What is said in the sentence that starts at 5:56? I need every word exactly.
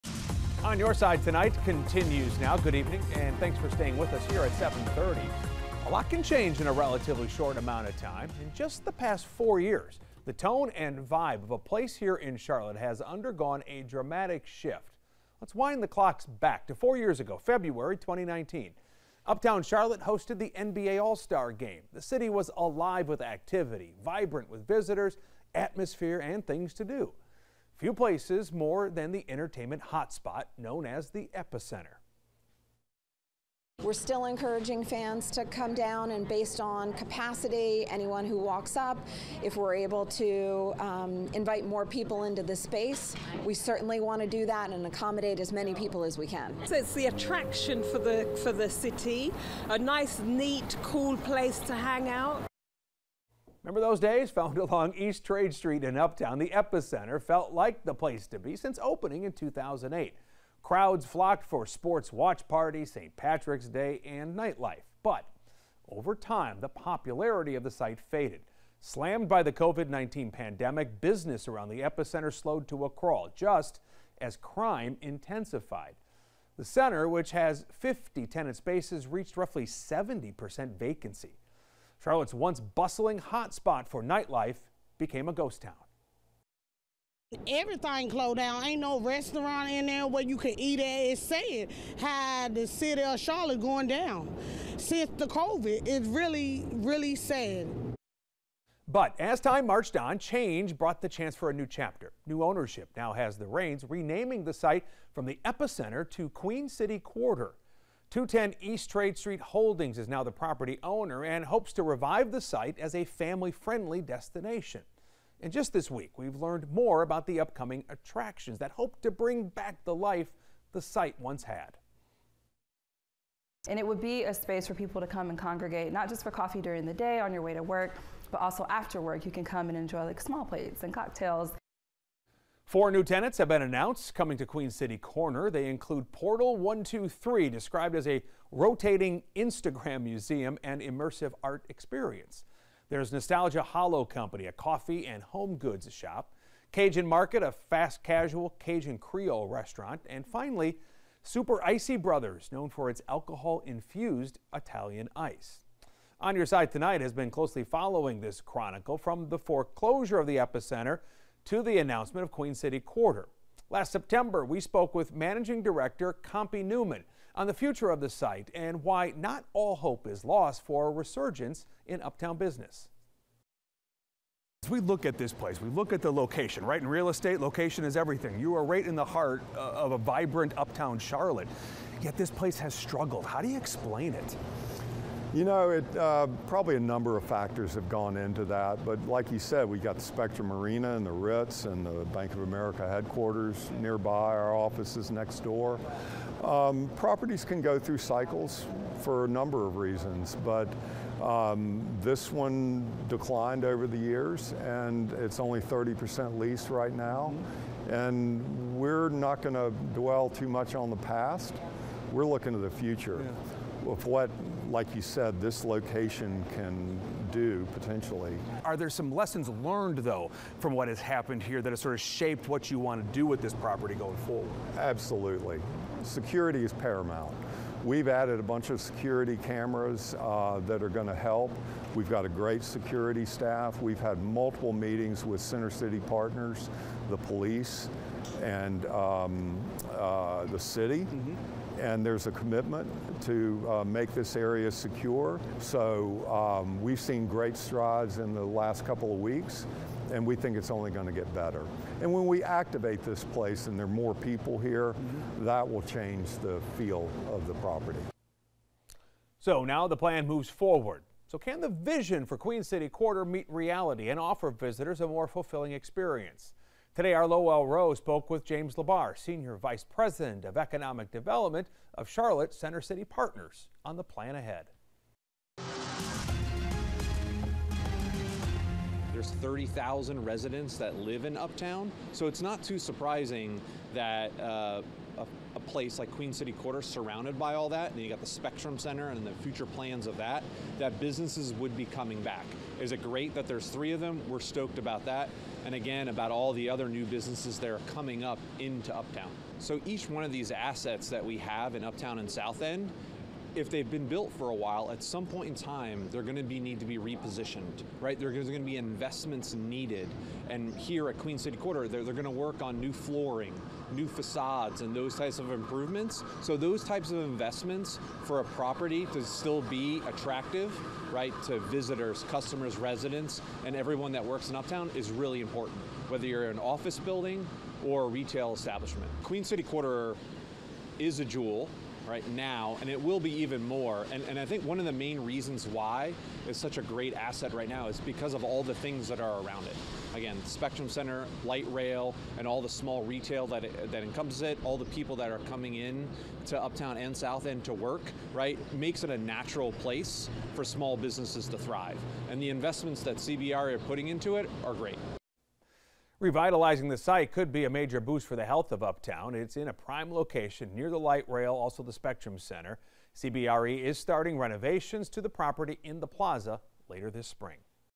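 Revitalizing the site could be a major boost for the health of Uptown.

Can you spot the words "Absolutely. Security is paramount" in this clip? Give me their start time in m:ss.
3:44.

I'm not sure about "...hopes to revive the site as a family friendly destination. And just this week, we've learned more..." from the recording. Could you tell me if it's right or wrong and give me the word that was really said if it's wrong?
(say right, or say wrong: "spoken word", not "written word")
right.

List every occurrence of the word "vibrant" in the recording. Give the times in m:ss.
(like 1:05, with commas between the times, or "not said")
0:24, 2:59.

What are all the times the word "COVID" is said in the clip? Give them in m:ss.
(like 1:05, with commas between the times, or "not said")
1:09, 1:35.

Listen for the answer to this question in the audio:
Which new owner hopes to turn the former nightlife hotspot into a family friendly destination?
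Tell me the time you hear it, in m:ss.
1:48.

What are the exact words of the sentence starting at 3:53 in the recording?
We've had multiple meetings with Center City partners, the police, and um, uh, the city.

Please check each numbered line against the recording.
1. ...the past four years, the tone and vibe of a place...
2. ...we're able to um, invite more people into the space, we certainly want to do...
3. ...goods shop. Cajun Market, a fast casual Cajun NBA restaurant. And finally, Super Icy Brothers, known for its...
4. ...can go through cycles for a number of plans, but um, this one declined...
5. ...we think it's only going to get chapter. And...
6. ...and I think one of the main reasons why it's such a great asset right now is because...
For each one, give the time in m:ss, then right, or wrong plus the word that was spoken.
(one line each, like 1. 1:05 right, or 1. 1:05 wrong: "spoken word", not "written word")
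1. 0:08 right
2. 0:39 right
3. 2:25 wrong: "Creole", not "NBA"
4. 3:17 wrong: "reasons", not "plans"
5. 4:10 wrong: "better", not "chapter"
6. 5:34 right.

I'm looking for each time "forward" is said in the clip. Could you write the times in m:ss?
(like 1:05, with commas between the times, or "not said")
3:44, 4:20.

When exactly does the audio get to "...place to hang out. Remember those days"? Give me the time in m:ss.
0:51.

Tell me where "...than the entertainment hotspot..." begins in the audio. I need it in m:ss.
0:28.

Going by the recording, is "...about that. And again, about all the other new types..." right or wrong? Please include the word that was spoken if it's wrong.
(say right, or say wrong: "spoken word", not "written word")
wrong: "businesses", not "types".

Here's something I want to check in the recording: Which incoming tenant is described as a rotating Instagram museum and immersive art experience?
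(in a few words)
Portal 123.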